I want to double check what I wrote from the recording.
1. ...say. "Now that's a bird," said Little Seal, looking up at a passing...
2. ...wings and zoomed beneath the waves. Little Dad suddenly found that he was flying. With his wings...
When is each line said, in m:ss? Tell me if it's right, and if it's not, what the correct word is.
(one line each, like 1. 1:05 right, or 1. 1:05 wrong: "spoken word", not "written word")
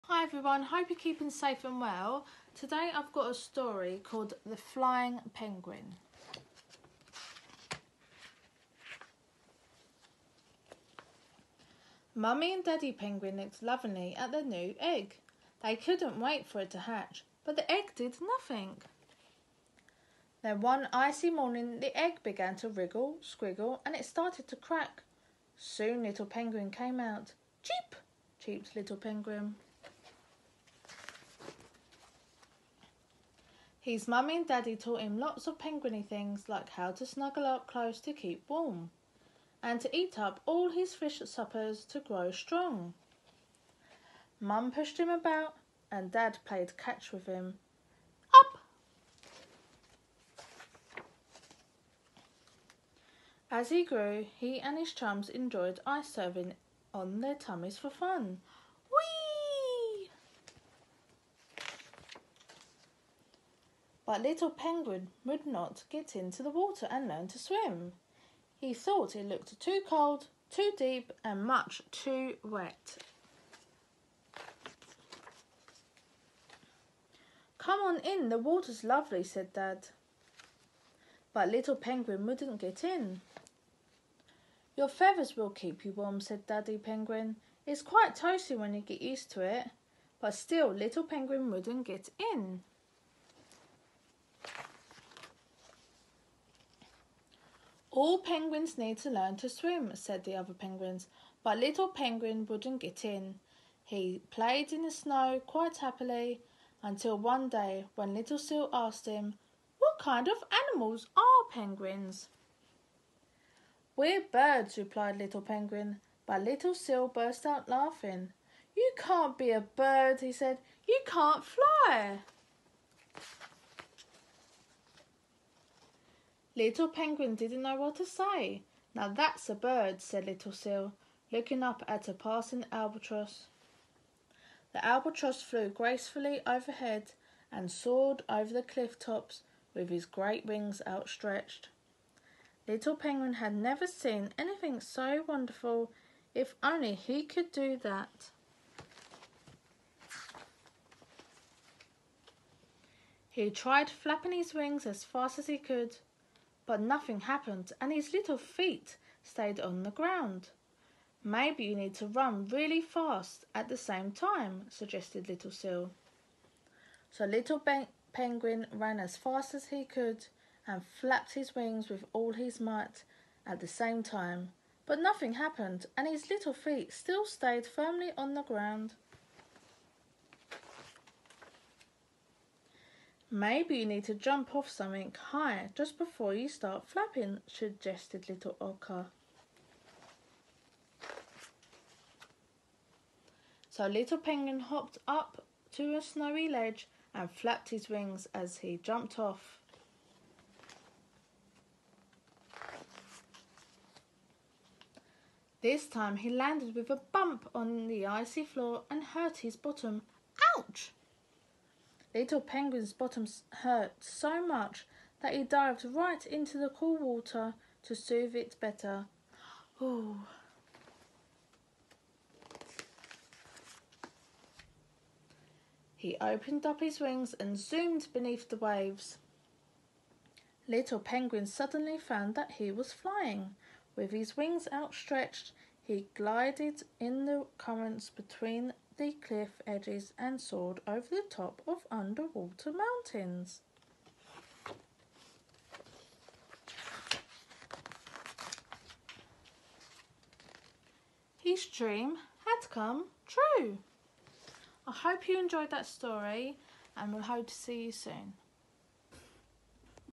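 1. 2:08 right
2. 3:46 wrong: "Penguin", not "Dad".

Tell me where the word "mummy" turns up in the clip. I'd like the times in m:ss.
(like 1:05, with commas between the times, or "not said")
0:12, 0:34.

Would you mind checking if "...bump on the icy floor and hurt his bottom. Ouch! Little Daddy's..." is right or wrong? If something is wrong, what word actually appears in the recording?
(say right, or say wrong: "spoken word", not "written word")
wrong: "Penguin", not "Daddy".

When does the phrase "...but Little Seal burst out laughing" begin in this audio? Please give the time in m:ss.
1:56.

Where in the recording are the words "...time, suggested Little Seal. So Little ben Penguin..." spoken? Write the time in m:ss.
2:44.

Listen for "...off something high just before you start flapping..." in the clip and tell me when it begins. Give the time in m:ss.
3:04.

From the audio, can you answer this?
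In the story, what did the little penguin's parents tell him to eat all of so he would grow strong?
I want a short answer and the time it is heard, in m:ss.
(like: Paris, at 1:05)
fish suppers, at 0:40.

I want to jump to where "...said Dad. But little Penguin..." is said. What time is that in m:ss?
1:19.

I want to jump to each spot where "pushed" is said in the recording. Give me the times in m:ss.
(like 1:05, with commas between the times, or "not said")
0:44.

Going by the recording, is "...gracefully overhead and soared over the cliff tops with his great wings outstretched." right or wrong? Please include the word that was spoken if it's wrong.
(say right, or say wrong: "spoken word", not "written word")
right.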